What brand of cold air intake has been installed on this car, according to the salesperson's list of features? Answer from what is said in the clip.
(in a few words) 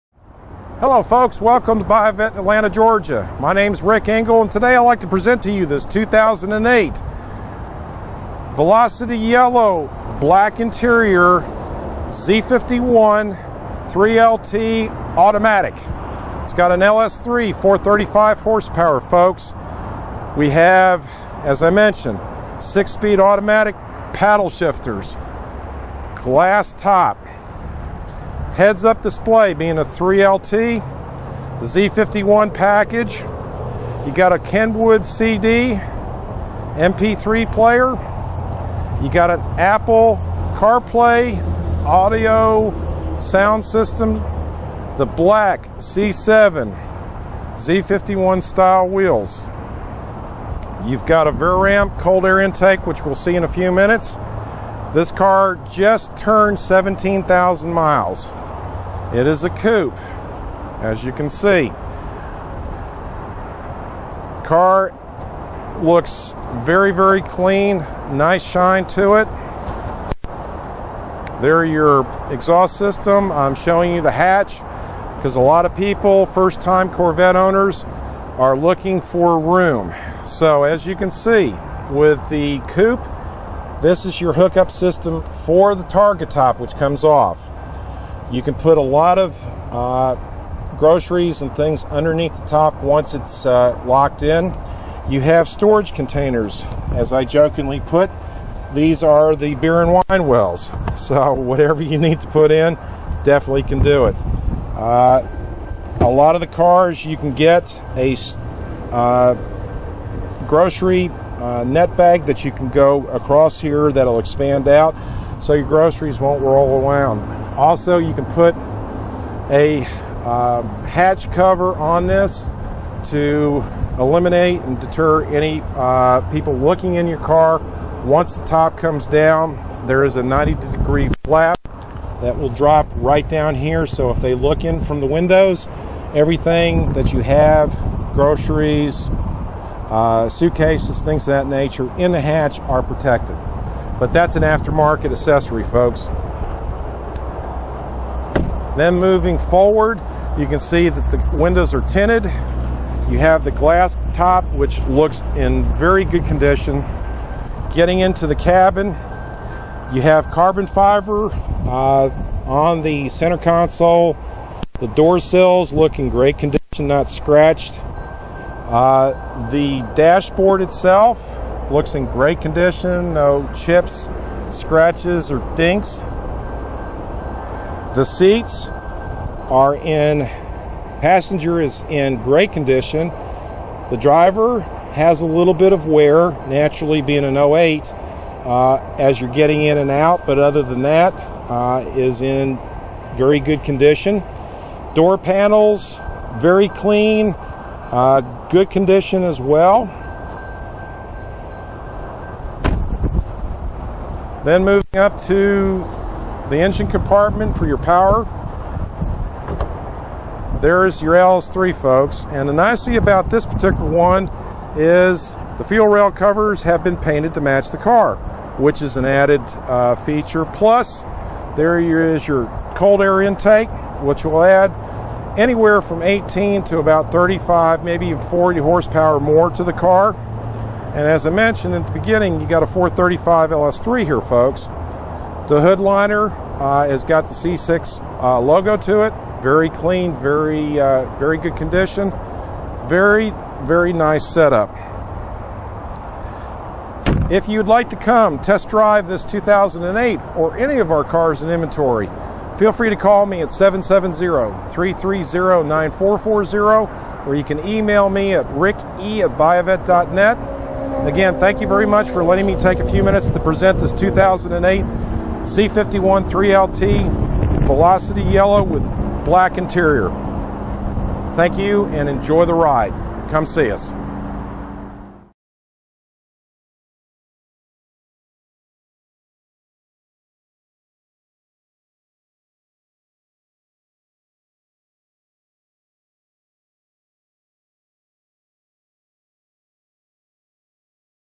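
Vararam.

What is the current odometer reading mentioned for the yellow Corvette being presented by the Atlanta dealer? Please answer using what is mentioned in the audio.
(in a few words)
17,000 miles.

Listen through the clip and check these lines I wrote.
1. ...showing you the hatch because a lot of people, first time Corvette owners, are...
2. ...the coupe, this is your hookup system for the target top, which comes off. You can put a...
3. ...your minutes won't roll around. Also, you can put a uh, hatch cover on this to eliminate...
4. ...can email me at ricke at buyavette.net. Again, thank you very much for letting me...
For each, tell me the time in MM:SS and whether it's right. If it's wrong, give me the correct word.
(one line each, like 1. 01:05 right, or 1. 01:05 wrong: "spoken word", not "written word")
1. 01:13 right
2. 01:22 right
3. 01:55 wrong: "groceries", not "minutes"
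4. 04:17 right.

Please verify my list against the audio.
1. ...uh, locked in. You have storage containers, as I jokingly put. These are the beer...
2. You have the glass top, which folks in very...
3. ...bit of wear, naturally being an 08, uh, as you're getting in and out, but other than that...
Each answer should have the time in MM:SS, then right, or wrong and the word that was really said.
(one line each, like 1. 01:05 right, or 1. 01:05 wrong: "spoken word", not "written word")
1. 01:33 right
2. 02:33 wrong: "looks", not "folks"
3. 03:05 right.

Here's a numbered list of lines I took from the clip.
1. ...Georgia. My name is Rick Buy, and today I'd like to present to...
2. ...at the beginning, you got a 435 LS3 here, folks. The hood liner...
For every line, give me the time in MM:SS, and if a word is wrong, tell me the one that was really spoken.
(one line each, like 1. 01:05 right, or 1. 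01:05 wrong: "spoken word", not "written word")
1. 00:02 wrong: "Engel", not "Buy"
2. 03:51 right.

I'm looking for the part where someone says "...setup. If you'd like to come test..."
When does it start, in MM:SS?
04:04.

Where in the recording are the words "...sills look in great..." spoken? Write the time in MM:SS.
02:45.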